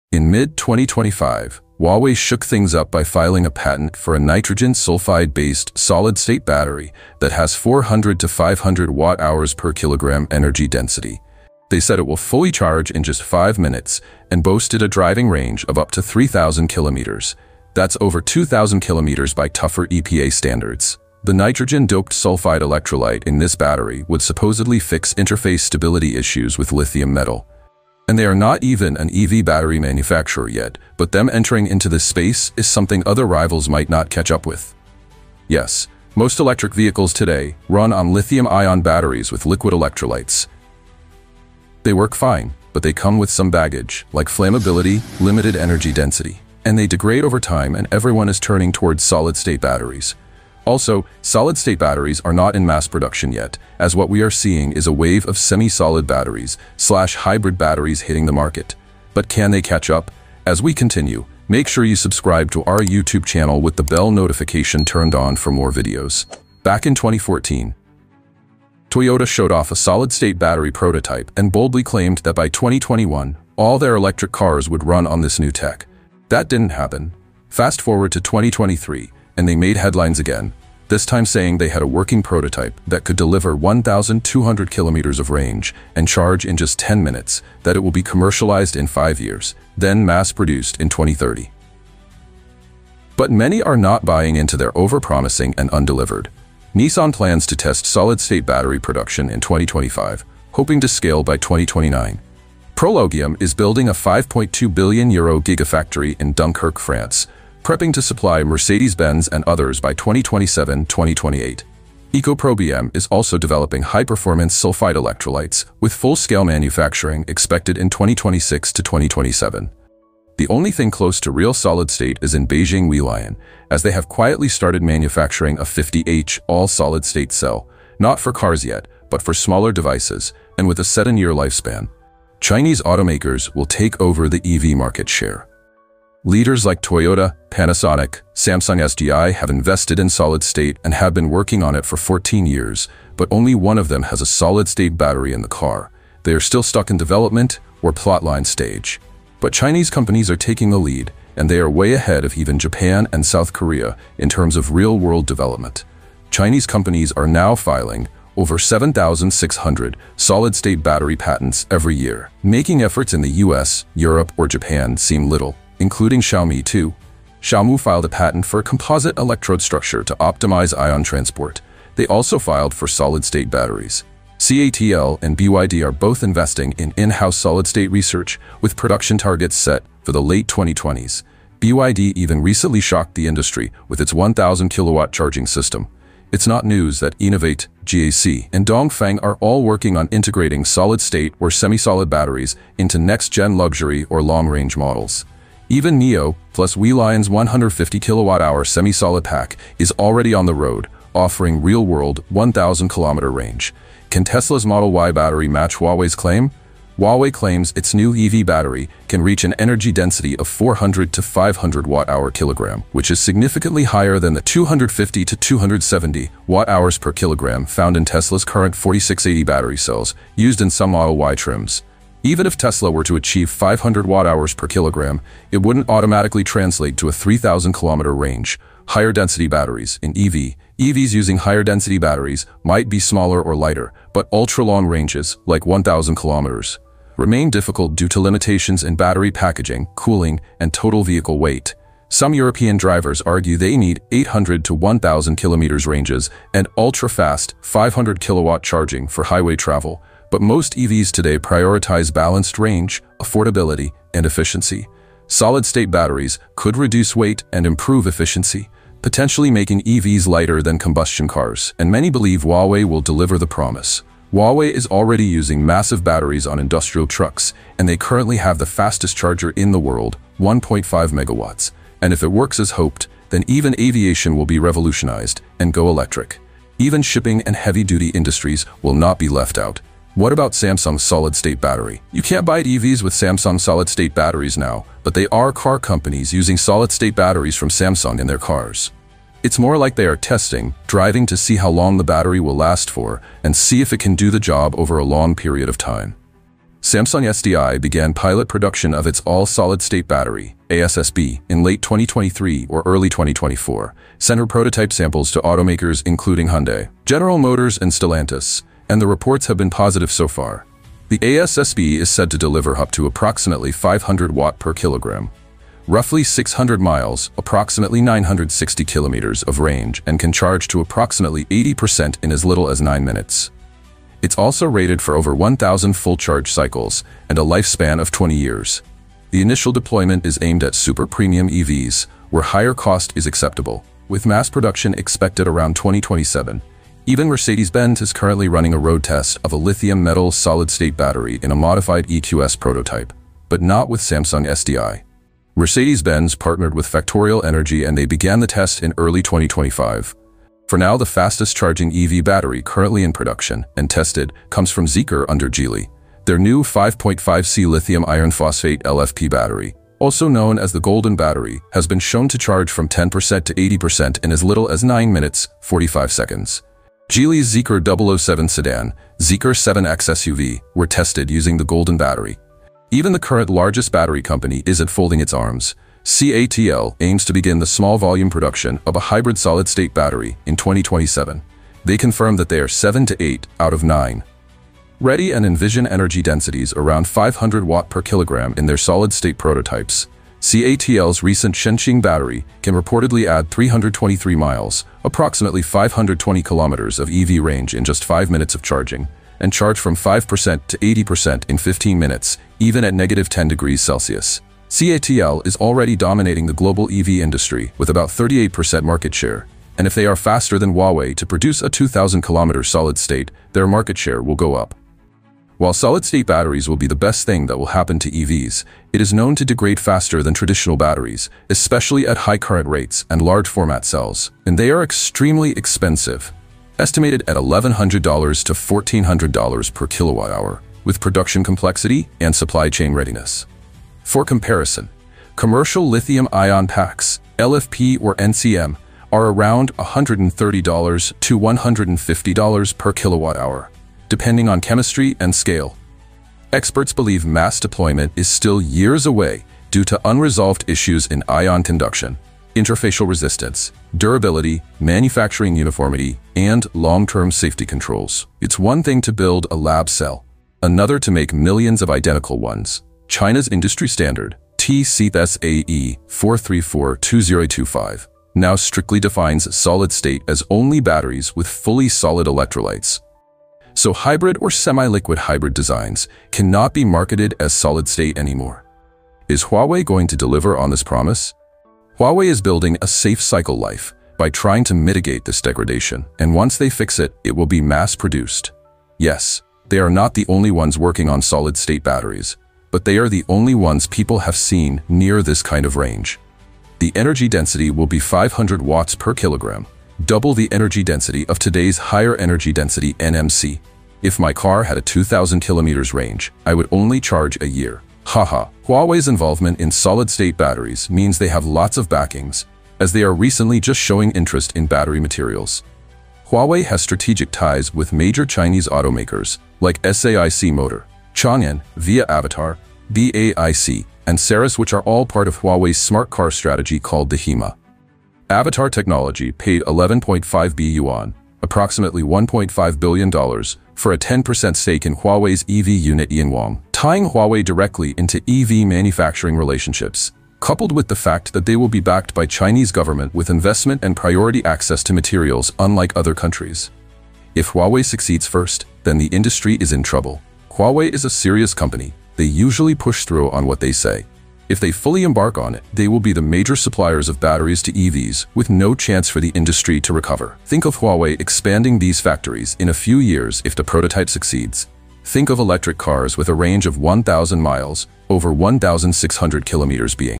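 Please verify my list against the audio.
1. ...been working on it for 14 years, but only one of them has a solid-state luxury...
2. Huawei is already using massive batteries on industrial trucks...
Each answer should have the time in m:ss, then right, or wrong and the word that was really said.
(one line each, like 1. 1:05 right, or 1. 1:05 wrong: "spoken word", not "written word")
1. 2:21 wrong: "battery", not "luxury"
2. 4:24 right.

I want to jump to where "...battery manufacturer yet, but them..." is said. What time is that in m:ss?
0:29.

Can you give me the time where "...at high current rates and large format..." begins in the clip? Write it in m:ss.
7:02.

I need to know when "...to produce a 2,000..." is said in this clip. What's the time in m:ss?
6:51.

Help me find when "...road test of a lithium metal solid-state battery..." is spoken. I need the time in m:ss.
5:38.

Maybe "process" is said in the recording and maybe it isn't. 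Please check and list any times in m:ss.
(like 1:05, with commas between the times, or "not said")
not said.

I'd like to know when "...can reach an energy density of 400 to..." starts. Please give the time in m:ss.
3:29.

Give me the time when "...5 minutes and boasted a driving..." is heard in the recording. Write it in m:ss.
0:13.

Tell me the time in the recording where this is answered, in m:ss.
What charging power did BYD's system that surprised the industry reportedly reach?
3:04.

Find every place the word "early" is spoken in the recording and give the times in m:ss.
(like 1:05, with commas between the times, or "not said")
5:02, 5:48.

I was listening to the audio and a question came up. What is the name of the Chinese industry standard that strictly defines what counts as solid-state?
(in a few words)
TCSAE 434-2025.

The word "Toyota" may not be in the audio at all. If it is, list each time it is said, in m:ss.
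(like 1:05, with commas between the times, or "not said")
1:08, 2:16.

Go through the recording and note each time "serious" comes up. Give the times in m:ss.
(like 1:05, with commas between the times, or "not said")
9:11.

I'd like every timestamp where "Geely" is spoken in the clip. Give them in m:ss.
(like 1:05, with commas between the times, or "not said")
5:55, 6:07.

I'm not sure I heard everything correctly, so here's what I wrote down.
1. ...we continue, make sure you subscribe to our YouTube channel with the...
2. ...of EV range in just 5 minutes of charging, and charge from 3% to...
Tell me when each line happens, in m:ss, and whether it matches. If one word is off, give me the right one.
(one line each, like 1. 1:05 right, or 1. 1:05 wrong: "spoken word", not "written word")
1. 1:00 right
2. 6:36 wrong: "5", not "3".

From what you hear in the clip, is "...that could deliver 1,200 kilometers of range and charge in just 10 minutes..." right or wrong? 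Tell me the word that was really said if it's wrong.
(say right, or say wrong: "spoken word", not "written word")
right.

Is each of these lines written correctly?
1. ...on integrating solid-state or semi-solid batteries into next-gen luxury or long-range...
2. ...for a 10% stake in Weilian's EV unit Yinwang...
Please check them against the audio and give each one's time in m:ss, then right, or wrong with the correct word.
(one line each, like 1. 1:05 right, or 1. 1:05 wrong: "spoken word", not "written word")
1. 3:09 right
2. 8:53 wrong: "Huawei", not "Weilian".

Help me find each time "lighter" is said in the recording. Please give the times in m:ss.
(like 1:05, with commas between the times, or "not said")
3:53, 4:20.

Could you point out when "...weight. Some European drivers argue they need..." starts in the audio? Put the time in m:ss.
4:01.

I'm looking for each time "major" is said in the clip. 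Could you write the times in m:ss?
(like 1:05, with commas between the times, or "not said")
8:37, 9:16.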